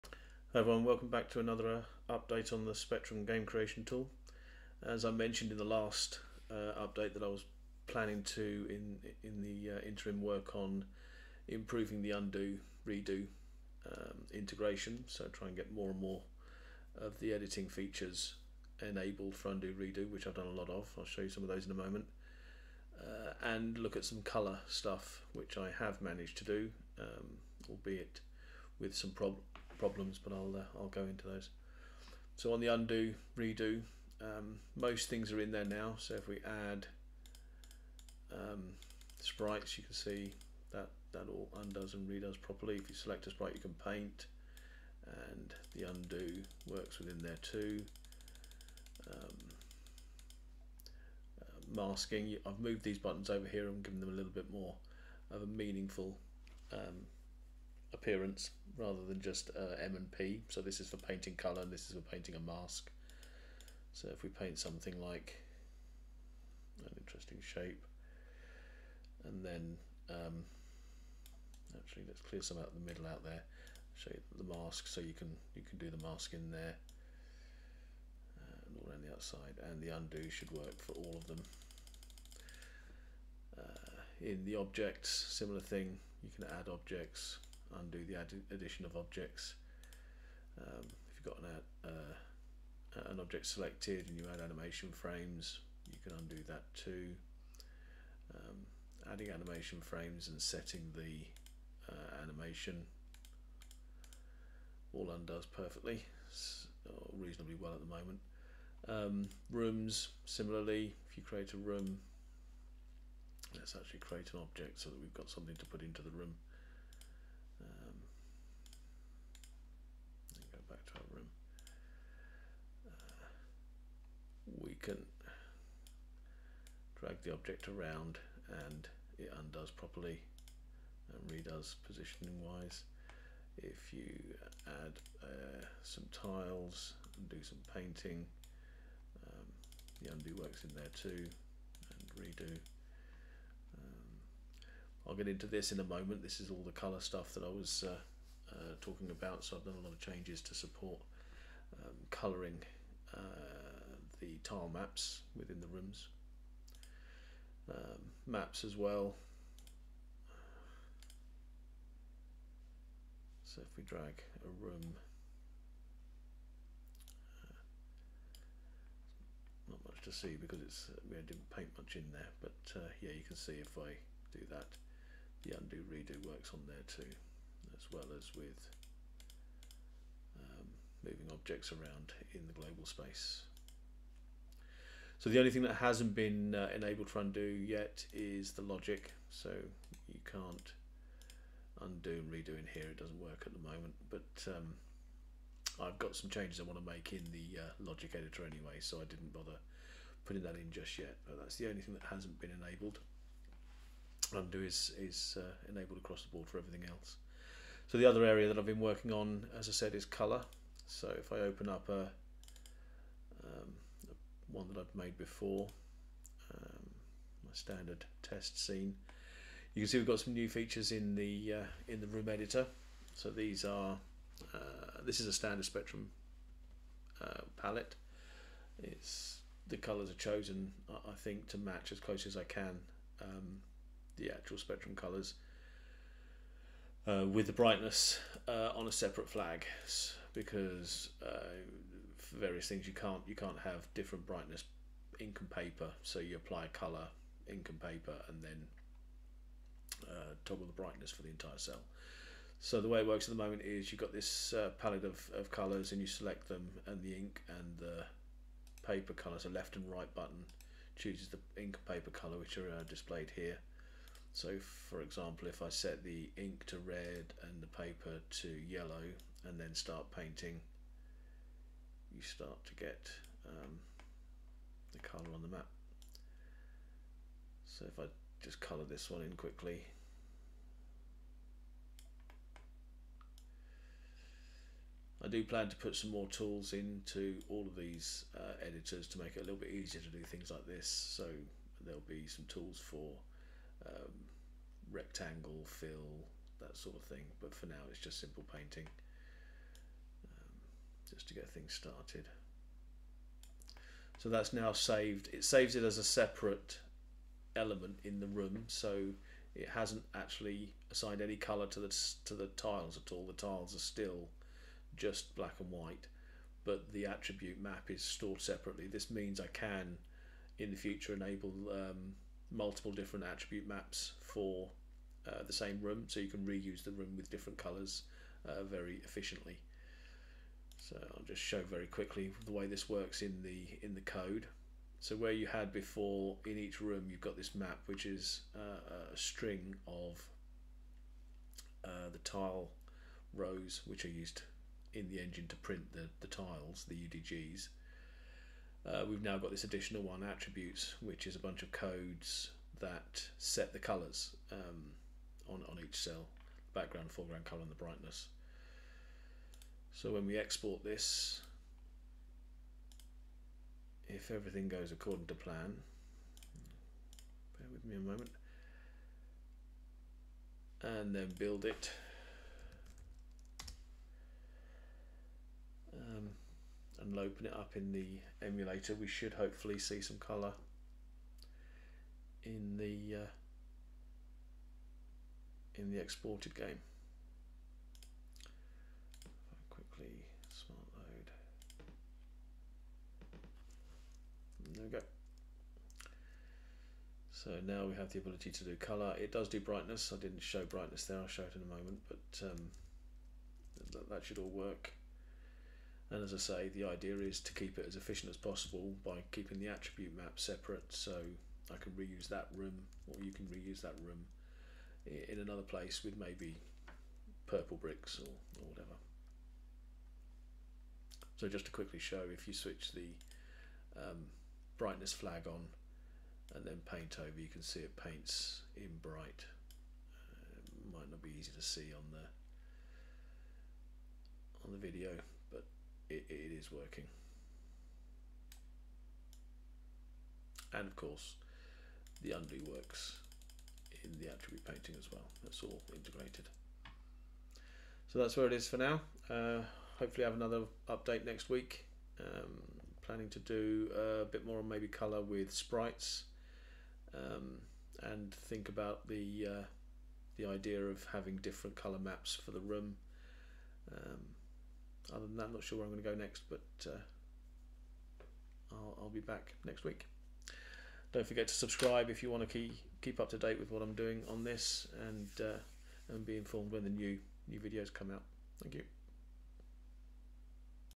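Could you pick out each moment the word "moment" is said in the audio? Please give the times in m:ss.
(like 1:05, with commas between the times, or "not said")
0:21, 1:47, 2:25, 3:13, 4:13, 6:07, 6:41.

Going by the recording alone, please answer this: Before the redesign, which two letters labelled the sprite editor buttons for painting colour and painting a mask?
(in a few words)
M and P.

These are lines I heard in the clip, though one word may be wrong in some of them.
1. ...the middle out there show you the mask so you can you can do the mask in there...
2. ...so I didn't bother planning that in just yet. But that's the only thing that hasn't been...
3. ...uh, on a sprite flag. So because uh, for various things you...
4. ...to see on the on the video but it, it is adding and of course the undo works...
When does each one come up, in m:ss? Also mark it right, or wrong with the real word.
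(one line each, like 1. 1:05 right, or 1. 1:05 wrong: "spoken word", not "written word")
1. 1:12 right
2. 3:18 wrong: "putting", not "planning"
3. 3:58 wrong: "separate", not "sprite"
4. 7:11 wrong: "working", not "adding".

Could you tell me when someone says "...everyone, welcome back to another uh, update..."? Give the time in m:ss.
0:00.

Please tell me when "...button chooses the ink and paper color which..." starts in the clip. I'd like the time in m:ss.
4:20.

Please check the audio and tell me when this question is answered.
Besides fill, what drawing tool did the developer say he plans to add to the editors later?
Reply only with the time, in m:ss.
4:54.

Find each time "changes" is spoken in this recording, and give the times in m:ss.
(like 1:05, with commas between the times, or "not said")
2:29, 3:16.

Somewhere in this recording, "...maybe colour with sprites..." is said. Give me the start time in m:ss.
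7:34.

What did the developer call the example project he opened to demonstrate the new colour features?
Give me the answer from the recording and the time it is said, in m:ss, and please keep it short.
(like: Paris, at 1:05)
my standard test scene, at 3:37.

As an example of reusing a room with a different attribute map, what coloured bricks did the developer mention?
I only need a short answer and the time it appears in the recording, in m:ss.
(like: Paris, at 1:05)
Purple bricks, at 6:57.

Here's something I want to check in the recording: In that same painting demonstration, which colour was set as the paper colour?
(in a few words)
Yellow.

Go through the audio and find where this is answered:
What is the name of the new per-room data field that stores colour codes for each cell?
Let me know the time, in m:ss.
5:50.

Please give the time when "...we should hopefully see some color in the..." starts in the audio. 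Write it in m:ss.
6:18.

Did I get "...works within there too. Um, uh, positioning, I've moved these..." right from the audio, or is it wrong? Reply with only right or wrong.
wrong.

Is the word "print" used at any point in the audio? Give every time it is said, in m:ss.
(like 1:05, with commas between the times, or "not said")
5:45.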